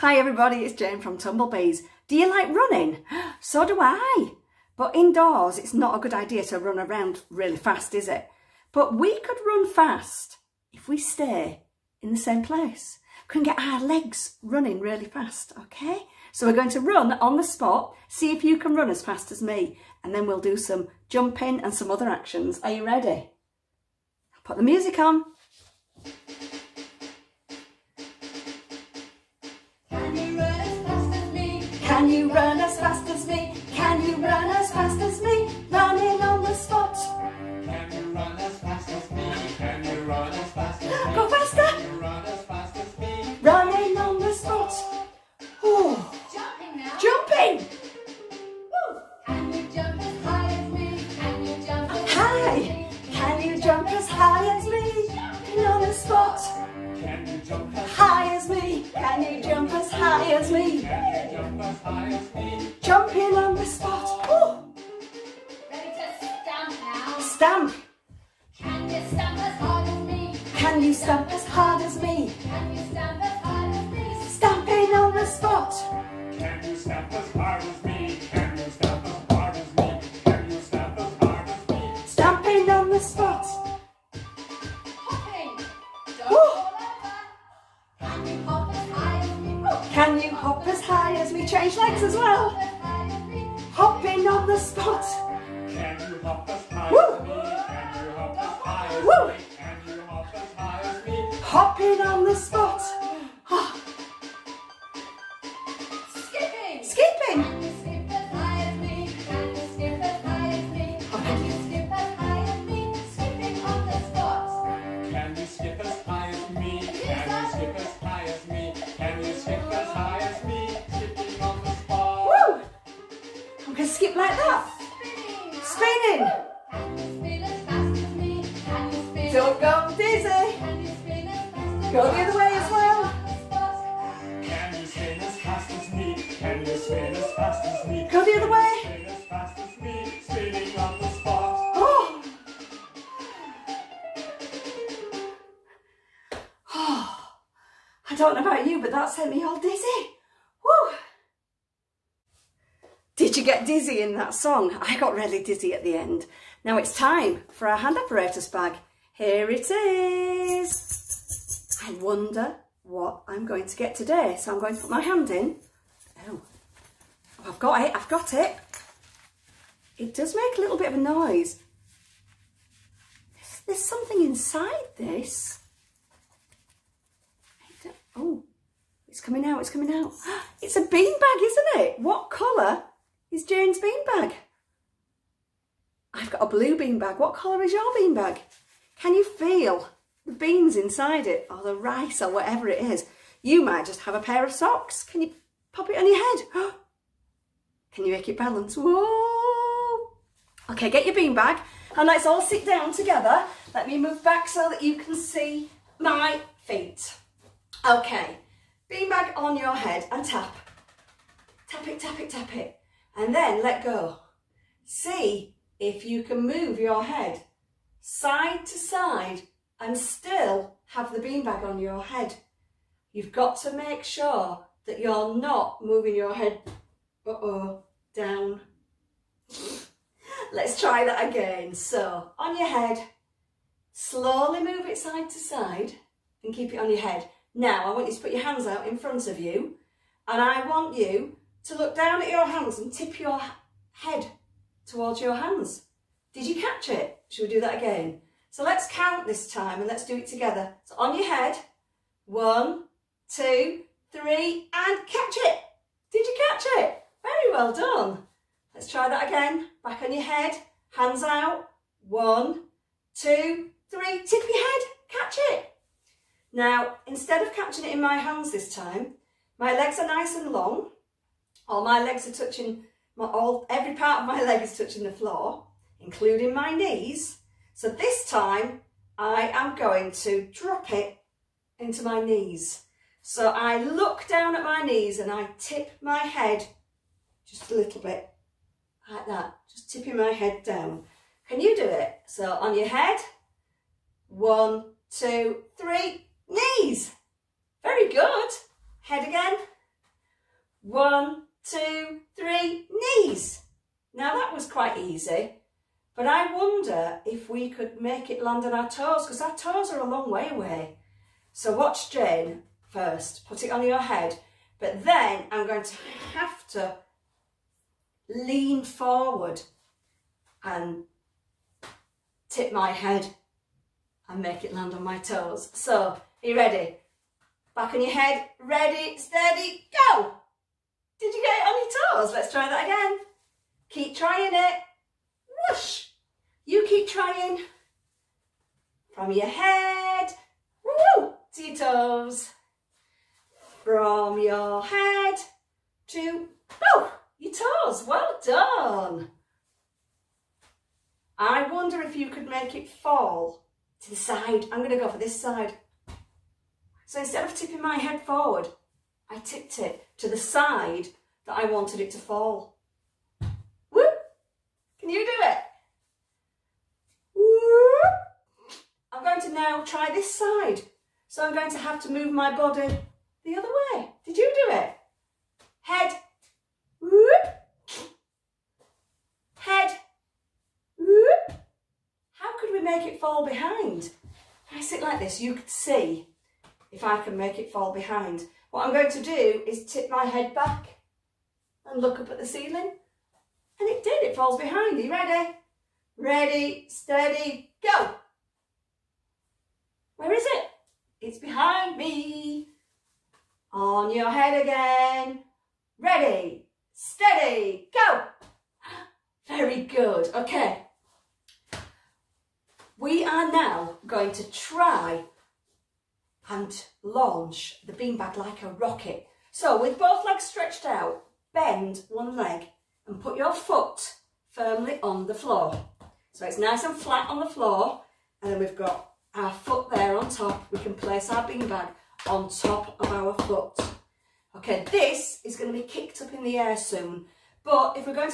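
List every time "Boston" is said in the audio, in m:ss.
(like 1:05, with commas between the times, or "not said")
not said.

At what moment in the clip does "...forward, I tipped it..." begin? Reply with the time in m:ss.
5:58.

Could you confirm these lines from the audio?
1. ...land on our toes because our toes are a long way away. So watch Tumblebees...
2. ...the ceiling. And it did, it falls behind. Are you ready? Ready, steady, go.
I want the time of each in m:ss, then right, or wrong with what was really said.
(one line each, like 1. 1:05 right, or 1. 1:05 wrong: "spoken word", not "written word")
1. 5:08 wrong: "Jane", not "Tumblebees"
2. 6:32 right.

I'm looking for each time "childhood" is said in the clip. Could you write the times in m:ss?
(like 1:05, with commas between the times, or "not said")
not said.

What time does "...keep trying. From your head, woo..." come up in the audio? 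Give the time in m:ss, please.
5:36.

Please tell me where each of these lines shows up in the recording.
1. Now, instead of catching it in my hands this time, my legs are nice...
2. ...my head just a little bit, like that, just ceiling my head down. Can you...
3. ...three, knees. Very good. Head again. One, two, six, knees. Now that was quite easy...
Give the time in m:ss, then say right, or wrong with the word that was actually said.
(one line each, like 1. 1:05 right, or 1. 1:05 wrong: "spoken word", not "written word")
1. 4:26 right
2. 4:46 wrong: "tipping", not "ceiling"
3. 4:55 wrong: "three", not "six".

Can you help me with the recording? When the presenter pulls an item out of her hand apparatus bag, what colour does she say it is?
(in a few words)
Blue.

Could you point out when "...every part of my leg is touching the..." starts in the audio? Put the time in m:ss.
4:33.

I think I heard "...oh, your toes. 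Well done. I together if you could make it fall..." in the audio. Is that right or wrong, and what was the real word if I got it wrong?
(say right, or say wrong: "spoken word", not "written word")
wrong: "wonder", not "together".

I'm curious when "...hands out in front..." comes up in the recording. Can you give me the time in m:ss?
3:58.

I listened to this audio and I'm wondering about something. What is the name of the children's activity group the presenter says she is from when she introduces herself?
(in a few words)
Tumblebees.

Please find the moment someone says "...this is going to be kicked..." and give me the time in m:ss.
7:14.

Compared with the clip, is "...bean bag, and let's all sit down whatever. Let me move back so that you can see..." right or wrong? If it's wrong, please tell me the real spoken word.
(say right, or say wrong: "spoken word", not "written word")
wrong: "together", not "whatever".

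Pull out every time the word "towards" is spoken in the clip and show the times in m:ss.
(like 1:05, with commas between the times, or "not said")
4:04.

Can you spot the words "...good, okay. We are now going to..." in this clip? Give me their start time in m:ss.
6:49.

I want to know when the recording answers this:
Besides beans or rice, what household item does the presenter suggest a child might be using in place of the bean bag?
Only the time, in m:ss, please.
3:14.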